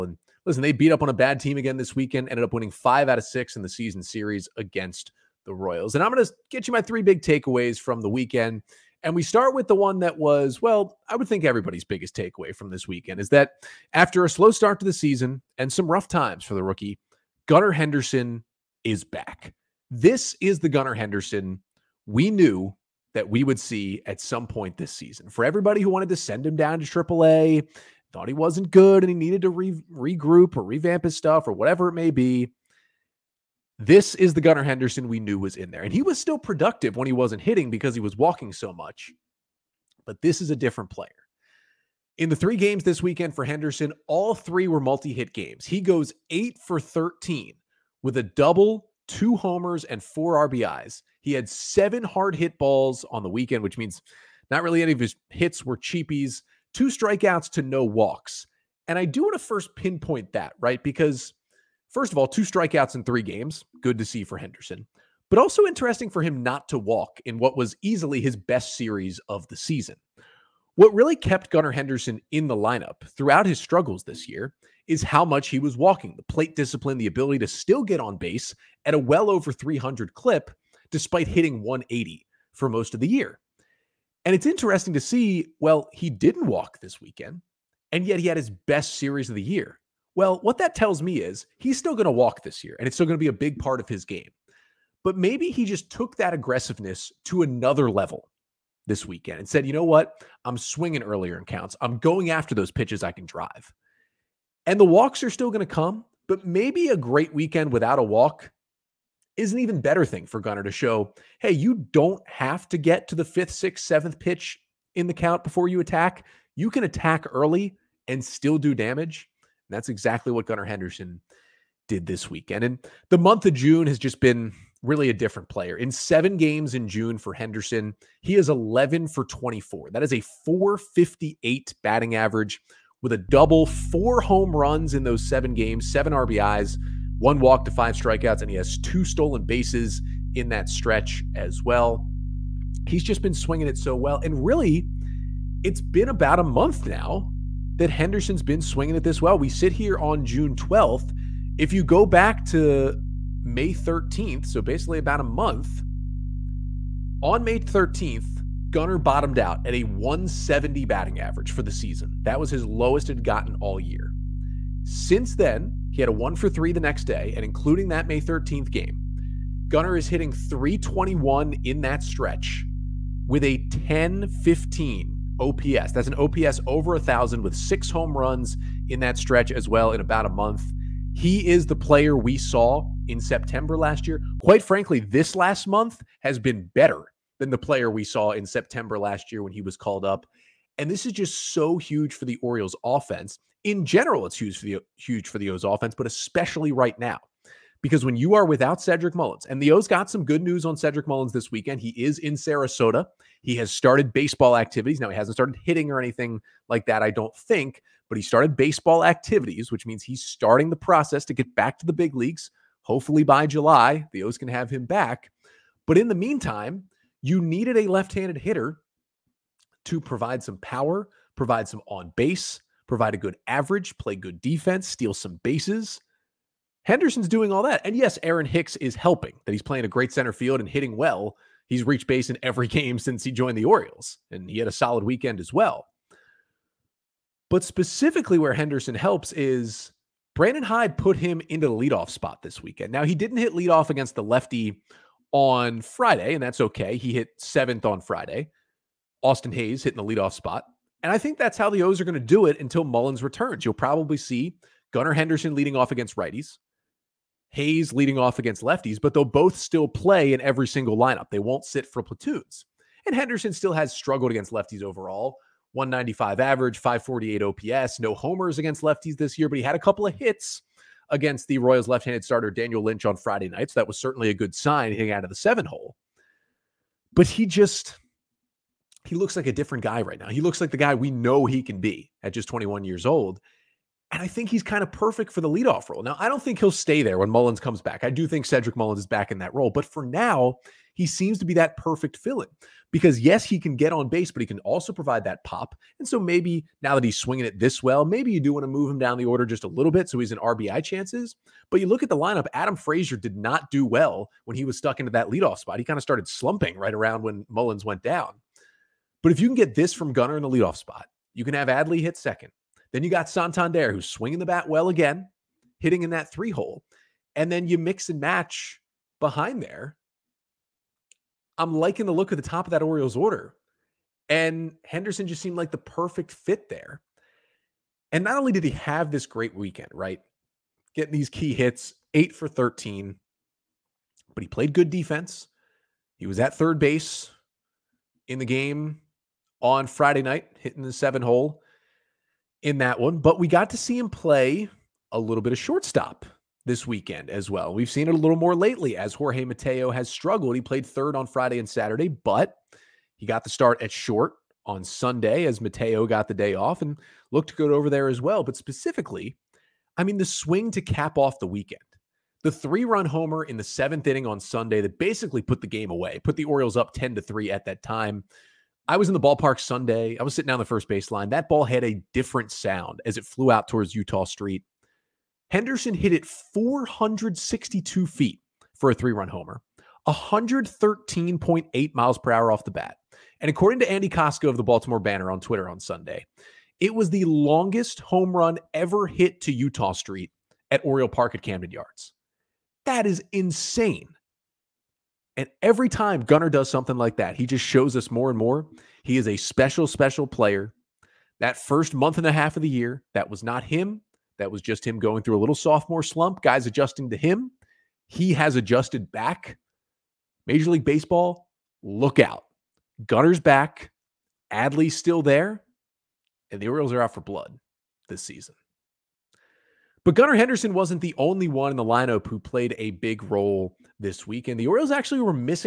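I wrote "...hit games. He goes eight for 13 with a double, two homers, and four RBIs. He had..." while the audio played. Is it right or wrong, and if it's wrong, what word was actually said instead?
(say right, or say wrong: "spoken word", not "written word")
right.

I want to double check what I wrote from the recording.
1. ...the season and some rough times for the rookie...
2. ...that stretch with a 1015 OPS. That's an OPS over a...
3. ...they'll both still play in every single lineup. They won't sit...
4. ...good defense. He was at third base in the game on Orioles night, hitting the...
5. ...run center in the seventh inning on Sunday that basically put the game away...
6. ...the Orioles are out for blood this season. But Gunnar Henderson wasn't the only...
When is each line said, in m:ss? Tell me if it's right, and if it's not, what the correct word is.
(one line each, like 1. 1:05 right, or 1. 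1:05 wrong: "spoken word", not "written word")
1. 0:14 right
2. 2:51 right
3. 4:19 right
4. 5:34 wrong: "Friday", not "Orioles"
5. 6:02 wrong: "homer", not "center"
6. 6:56 right.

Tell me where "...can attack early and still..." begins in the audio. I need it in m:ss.
1:56.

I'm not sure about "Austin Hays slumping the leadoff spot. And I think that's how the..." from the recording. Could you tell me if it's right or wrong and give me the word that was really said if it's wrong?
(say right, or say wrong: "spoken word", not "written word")
wrong: "hitting", not "slumping".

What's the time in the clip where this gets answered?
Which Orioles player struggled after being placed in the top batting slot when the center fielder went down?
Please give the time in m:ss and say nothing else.
5:02.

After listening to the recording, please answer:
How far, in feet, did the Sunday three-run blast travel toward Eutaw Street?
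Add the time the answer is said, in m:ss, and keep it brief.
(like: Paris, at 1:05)
462 feet, at 6:16.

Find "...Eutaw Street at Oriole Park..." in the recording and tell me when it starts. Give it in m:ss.
6:29.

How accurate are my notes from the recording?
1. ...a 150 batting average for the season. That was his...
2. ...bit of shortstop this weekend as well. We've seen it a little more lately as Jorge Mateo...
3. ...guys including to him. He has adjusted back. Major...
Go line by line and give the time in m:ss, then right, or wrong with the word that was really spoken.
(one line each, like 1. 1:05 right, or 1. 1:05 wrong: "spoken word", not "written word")
1. 2:39 wrong: "170", not "150"
2. 5:45 right
3. 6:46 wrong: "adjusting", not "including".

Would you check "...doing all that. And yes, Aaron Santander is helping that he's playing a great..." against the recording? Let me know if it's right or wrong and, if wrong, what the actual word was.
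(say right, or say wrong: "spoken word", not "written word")
wrong: "Hicks", not "Santander".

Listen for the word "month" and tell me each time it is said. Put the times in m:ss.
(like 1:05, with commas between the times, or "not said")
2:03, 2:26, 2:35, 3:00, 3:05, 6:41.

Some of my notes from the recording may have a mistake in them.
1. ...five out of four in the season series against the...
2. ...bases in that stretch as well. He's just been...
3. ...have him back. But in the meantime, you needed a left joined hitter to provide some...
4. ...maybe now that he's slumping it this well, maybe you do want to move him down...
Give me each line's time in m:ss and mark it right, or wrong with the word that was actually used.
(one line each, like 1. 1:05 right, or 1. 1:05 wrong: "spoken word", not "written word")
1. 0:02 wrong: "six", not "four"
2. 2:19 right
3. 3:34 wrong: "handed", not "joined"
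4. 4:56 wrong: "swinging", not "slumping".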